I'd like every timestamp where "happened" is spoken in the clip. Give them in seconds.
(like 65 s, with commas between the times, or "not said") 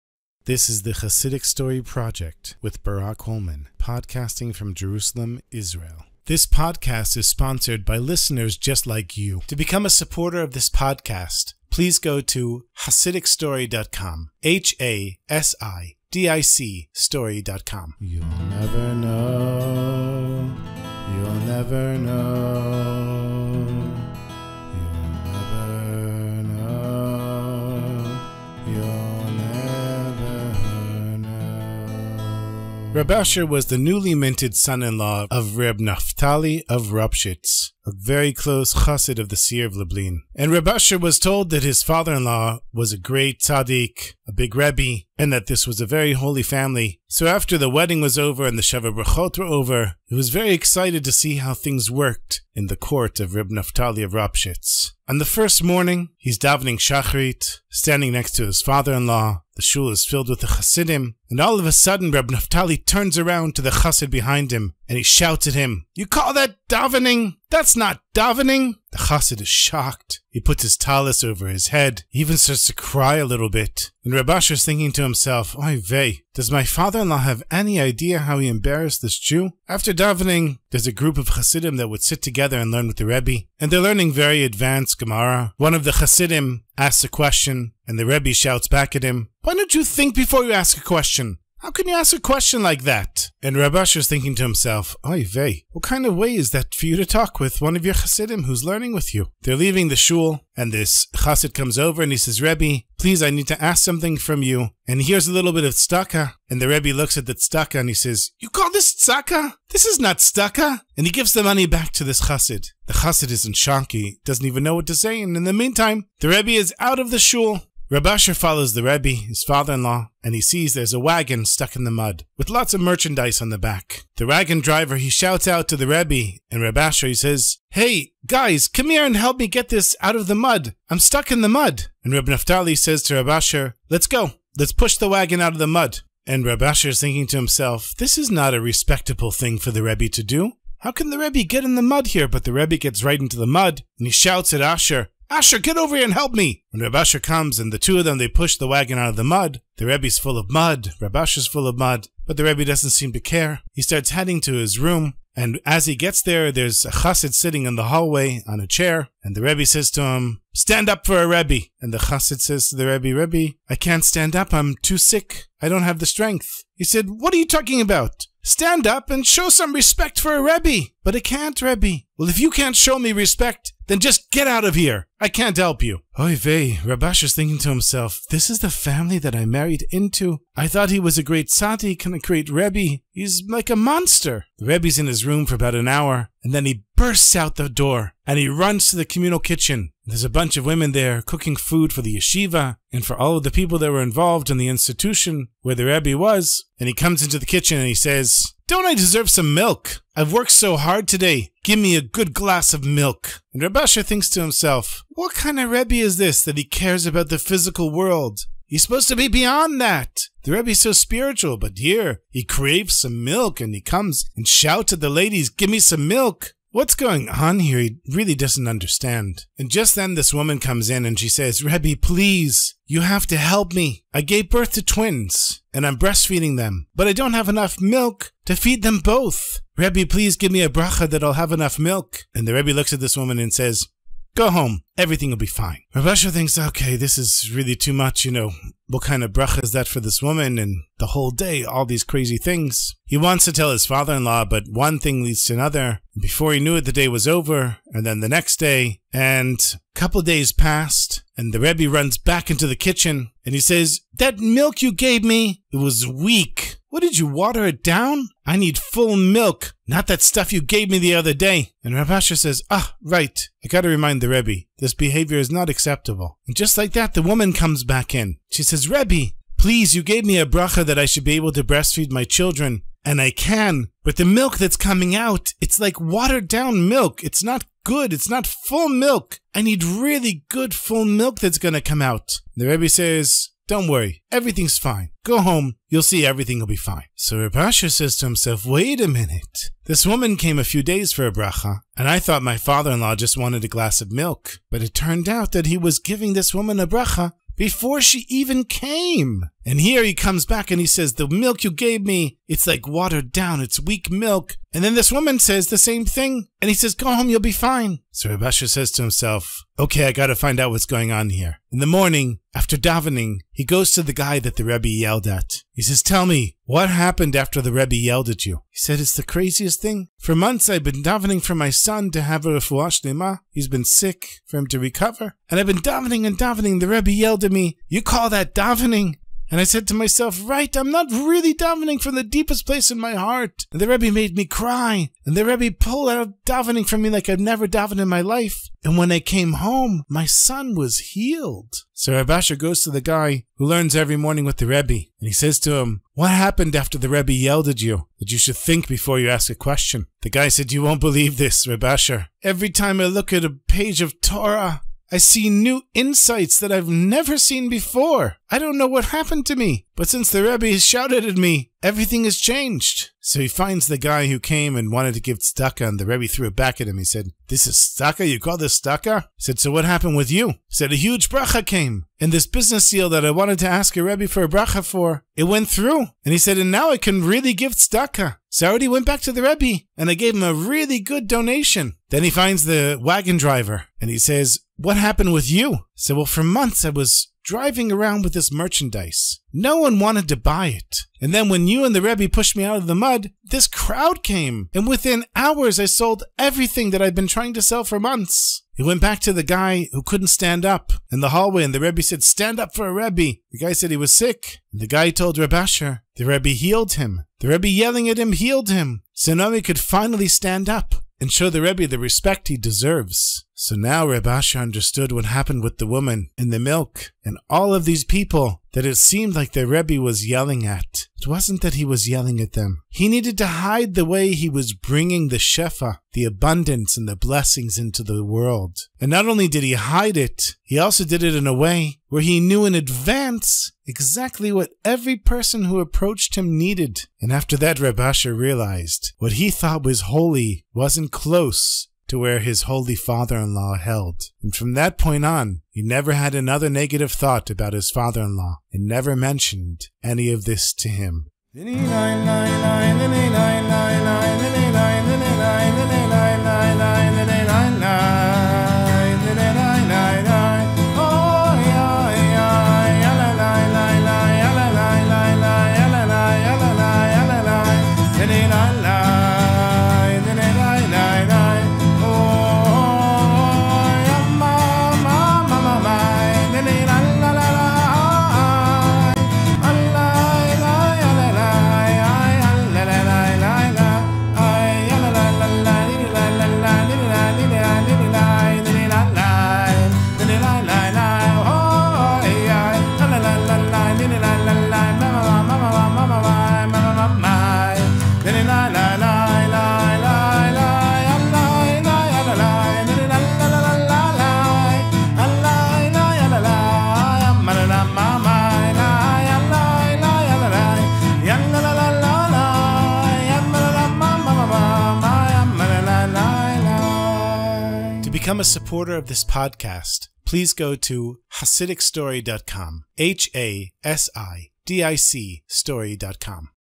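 316 s, 346 s, 359 s, 369 s, 384 s, 415 s.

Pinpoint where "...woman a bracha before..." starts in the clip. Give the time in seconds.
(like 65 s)
296 s.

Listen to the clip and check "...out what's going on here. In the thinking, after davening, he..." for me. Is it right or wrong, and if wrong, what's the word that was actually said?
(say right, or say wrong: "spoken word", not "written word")
wrong: "morning", not "thinking".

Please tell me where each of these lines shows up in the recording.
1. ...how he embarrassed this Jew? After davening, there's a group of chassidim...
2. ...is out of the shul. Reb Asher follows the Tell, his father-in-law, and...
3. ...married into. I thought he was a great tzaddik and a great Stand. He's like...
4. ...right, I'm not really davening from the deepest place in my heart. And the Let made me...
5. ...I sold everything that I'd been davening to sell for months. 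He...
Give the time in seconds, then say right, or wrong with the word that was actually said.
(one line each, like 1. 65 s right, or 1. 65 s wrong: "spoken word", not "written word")
1. 78 s right
2. 116 s wrong: "Rebbe", not "Tell"
3. 179 s wrong: "Rebbe", not "Stand"
4. 330 s wrong: "Rebbe", not "Let"
5. 395 s wrong: "trying", not "davening".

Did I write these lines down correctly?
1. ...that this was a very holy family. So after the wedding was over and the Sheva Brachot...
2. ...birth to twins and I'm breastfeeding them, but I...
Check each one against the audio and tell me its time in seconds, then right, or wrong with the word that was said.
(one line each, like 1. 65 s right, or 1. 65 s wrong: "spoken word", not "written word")
1. 45 s right
2. 224 s right.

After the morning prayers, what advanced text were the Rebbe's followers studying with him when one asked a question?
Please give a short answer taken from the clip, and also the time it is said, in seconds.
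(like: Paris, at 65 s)
Gemara, at 84 s.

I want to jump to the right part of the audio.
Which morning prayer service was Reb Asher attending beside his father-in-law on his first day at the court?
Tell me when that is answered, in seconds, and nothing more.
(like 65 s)
56 s.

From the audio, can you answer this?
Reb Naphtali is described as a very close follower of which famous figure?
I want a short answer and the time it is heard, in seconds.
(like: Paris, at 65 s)
the seer of Lublin, at 39 s.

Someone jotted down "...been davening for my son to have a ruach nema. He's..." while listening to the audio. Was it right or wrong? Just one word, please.
right.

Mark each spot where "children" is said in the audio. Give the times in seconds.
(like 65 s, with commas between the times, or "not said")
272 s.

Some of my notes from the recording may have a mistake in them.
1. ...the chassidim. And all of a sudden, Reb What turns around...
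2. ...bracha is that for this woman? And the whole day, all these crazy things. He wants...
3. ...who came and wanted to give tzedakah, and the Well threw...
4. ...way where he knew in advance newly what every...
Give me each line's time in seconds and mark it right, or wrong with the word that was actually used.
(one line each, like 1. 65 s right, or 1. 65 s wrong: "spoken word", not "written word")
1. 60 s wrong: "Naftali", not "What"
2. 239 s right
3. 364 s wrong: "Rebbe", not "Well"
4. 431 s wrong: "exactly", not "newly".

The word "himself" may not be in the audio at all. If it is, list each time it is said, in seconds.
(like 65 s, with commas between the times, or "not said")
75 s, 94 s, 137 s, 177 s, 204 s, 288 s, 309 s.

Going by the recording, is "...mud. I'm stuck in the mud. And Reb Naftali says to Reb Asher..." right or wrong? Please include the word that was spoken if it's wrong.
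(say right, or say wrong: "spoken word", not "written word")
right.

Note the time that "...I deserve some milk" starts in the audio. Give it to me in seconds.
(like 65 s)
198 s.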